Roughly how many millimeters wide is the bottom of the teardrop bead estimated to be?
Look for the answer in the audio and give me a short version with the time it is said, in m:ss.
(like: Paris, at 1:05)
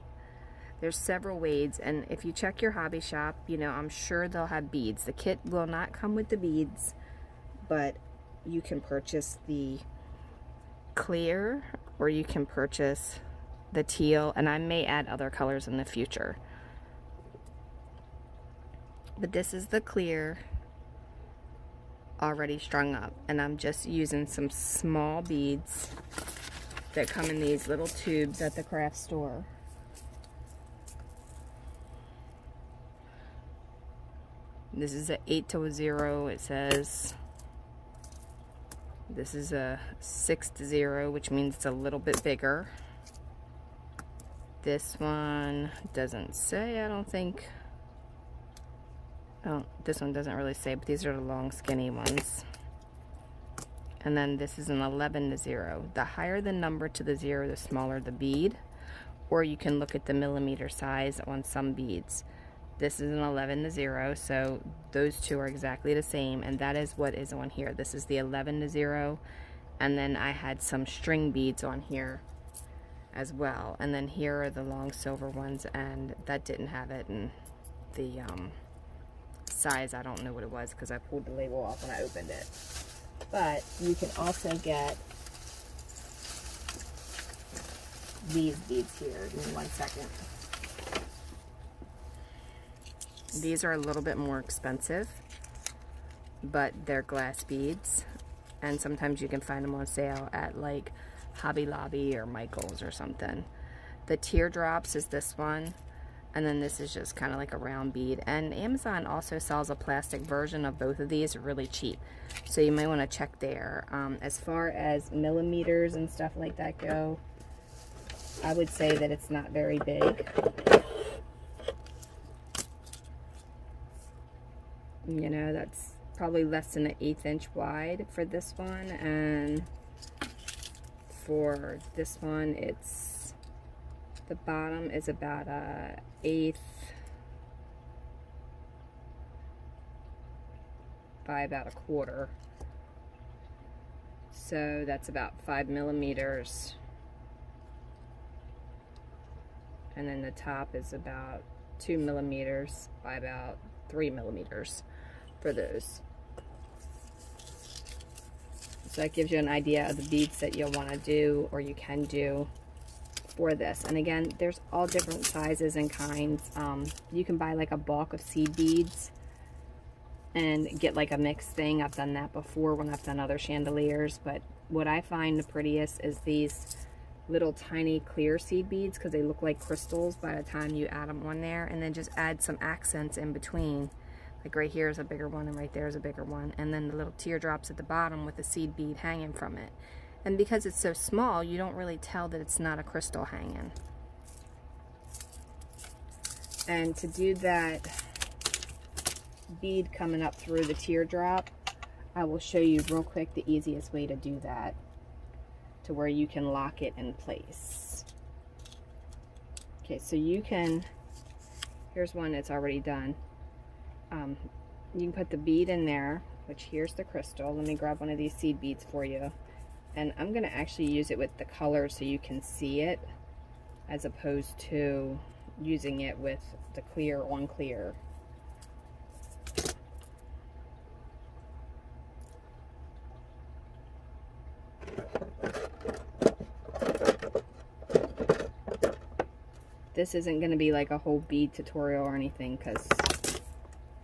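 5 millimeters, at 2:25.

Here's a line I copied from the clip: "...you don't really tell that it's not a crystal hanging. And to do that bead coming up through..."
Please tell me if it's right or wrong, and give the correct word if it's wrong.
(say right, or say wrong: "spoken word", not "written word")
right.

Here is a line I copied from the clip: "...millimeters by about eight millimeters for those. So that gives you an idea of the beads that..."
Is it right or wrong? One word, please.
wrong.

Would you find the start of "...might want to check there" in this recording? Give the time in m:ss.
1:52.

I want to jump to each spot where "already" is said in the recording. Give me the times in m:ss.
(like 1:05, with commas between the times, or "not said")
0:22, 3:32.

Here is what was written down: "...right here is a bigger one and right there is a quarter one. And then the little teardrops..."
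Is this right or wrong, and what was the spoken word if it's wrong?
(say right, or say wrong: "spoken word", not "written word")
wrong: "bigger", not "quarter".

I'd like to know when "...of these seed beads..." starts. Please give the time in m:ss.
3:38.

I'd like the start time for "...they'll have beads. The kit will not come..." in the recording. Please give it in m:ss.
0:04.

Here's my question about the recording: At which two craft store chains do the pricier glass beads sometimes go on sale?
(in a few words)
Hobby Lobby or Michael's.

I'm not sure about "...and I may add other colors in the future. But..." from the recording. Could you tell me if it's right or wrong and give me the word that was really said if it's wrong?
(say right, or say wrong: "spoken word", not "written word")
right.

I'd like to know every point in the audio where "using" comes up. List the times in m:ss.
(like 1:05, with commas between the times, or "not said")
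0:23, 3:45.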